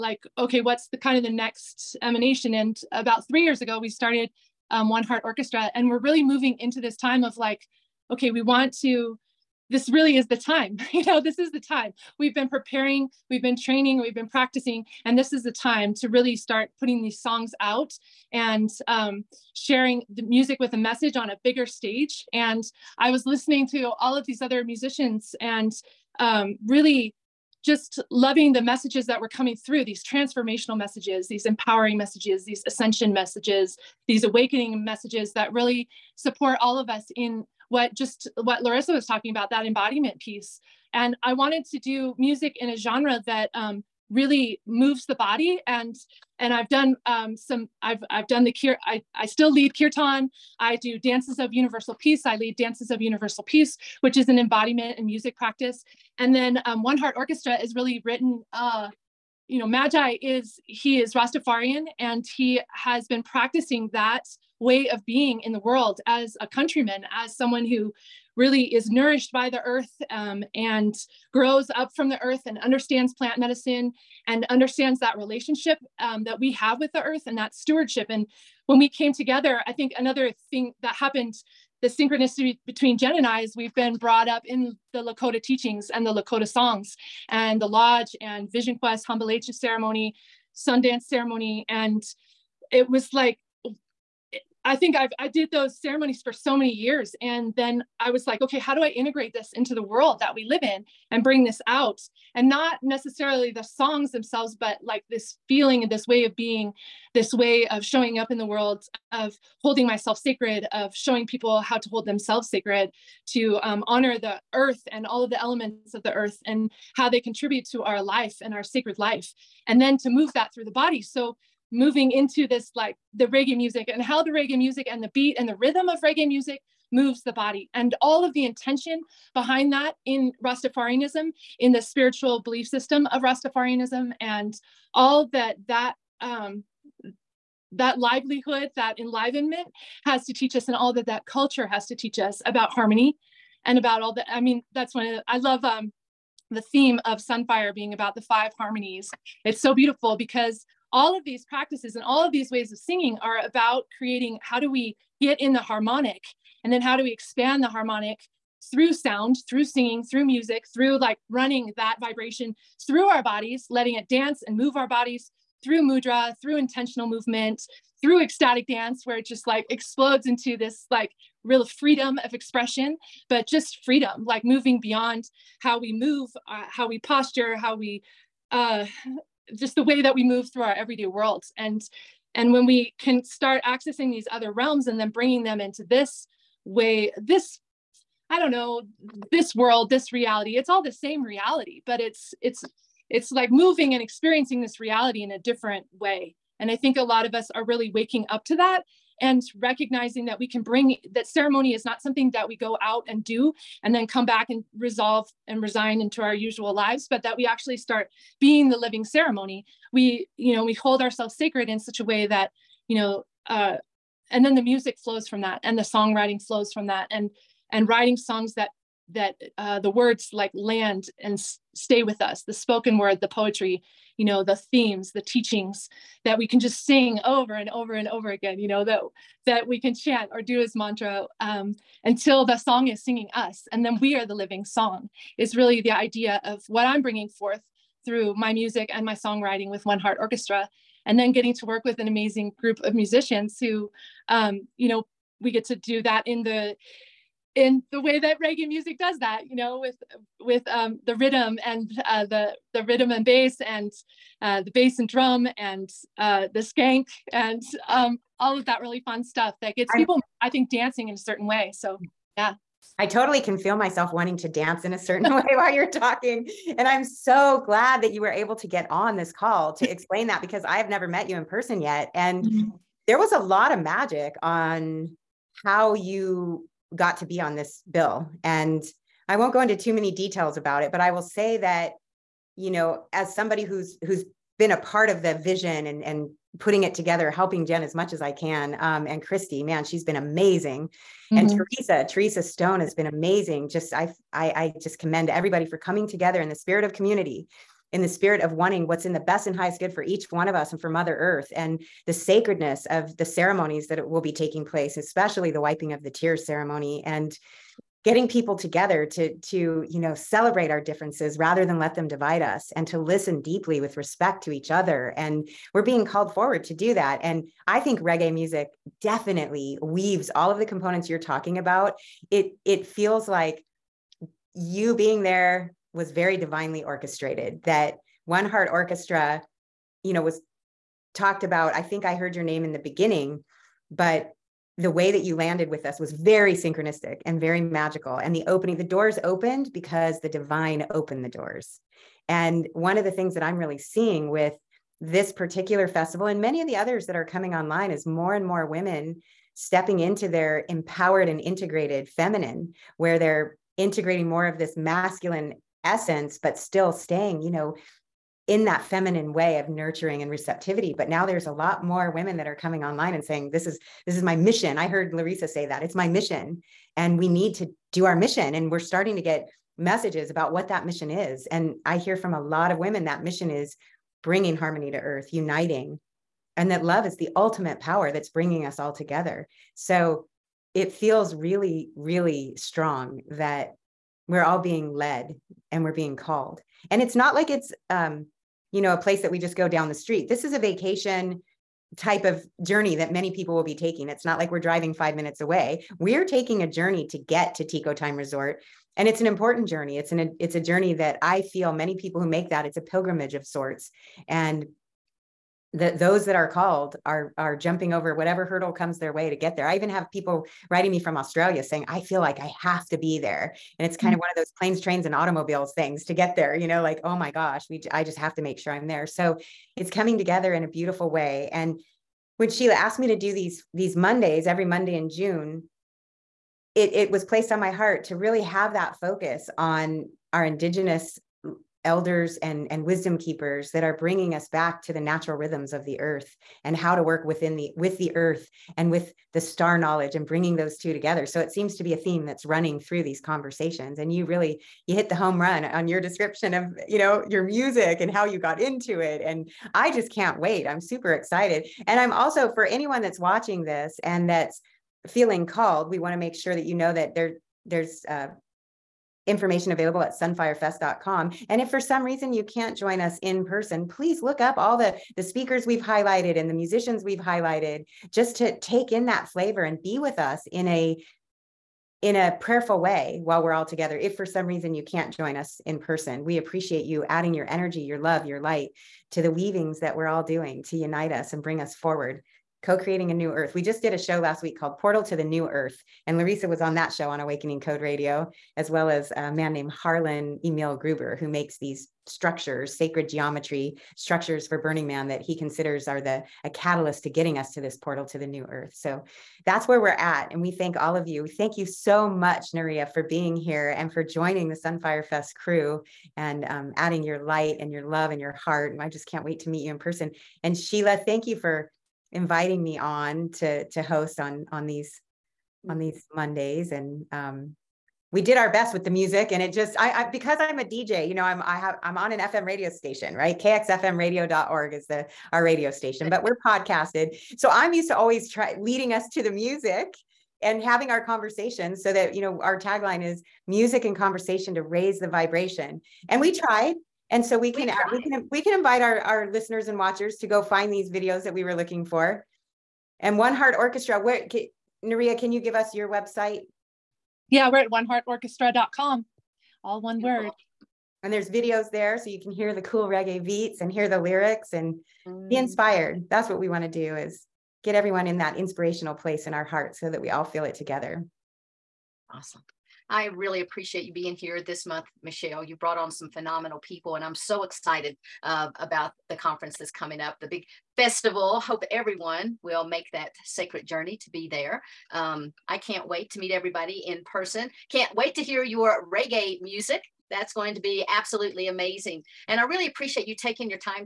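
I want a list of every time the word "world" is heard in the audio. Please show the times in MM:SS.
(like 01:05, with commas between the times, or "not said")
01:05, 01:39, 01:48, 03:01, 03:09.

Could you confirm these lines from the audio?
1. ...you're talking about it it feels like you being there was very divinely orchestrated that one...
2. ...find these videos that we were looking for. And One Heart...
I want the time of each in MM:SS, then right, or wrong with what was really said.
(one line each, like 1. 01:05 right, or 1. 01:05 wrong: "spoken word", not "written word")
1. 05:21 right
2. 09:00 right.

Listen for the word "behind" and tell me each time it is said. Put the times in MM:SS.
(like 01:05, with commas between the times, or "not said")
02:09.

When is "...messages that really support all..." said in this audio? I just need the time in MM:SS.
00:34.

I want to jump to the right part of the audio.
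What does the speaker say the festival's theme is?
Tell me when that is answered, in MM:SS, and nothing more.
02:28.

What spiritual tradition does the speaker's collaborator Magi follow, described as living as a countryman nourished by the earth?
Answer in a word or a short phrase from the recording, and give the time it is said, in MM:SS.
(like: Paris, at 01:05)
Rastafarian, at 01:01.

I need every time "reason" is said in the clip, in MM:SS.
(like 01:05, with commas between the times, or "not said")
07:42, 07:54.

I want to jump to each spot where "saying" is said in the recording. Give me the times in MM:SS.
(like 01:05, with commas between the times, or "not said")
06:03, 06:51.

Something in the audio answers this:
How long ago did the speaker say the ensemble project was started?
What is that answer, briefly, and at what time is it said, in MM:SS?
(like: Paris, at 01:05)
3 years ago, at 00:02.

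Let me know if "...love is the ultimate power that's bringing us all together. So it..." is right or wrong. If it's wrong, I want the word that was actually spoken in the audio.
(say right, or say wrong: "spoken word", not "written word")
right.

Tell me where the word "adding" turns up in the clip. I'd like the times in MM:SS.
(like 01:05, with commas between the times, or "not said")
07:57, 08:26.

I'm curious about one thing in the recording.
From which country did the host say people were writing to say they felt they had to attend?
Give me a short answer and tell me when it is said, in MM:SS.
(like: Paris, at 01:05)
Australia, at 06:51.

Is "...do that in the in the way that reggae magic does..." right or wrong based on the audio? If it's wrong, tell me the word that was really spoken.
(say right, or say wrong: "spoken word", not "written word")
wrong: "music", not "magic".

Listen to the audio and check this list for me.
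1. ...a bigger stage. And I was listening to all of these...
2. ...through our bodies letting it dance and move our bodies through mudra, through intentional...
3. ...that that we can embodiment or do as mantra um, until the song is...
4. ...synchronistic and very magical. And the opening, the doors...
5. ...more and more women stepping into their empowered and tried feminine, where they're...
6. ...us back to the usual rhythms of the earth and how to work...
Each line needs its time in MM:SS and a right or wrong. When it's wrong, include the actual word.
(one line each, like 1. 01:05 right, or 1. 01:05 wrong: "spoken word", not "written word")
1. 00:21 right
2. 02:42 right
3. 03:48 wrong: "chant", not "embodiment"
4. 05:36 right
5. 05:48 wrong: "integrated", not "tried"
6. 07:14 wrong: "natural", not "usual".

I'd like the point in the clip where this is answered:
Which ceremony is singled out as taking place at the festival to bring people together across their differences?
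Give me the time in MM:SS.
05:05.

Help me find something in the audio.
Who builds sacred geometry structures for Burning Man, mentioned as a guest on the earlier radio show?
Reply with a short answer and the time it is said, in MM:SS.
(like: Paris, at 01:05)
Harlan Emil Gruber, at 08:09.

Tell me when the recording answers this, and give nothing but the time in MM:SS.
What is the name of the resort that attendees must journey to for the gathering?
06:37.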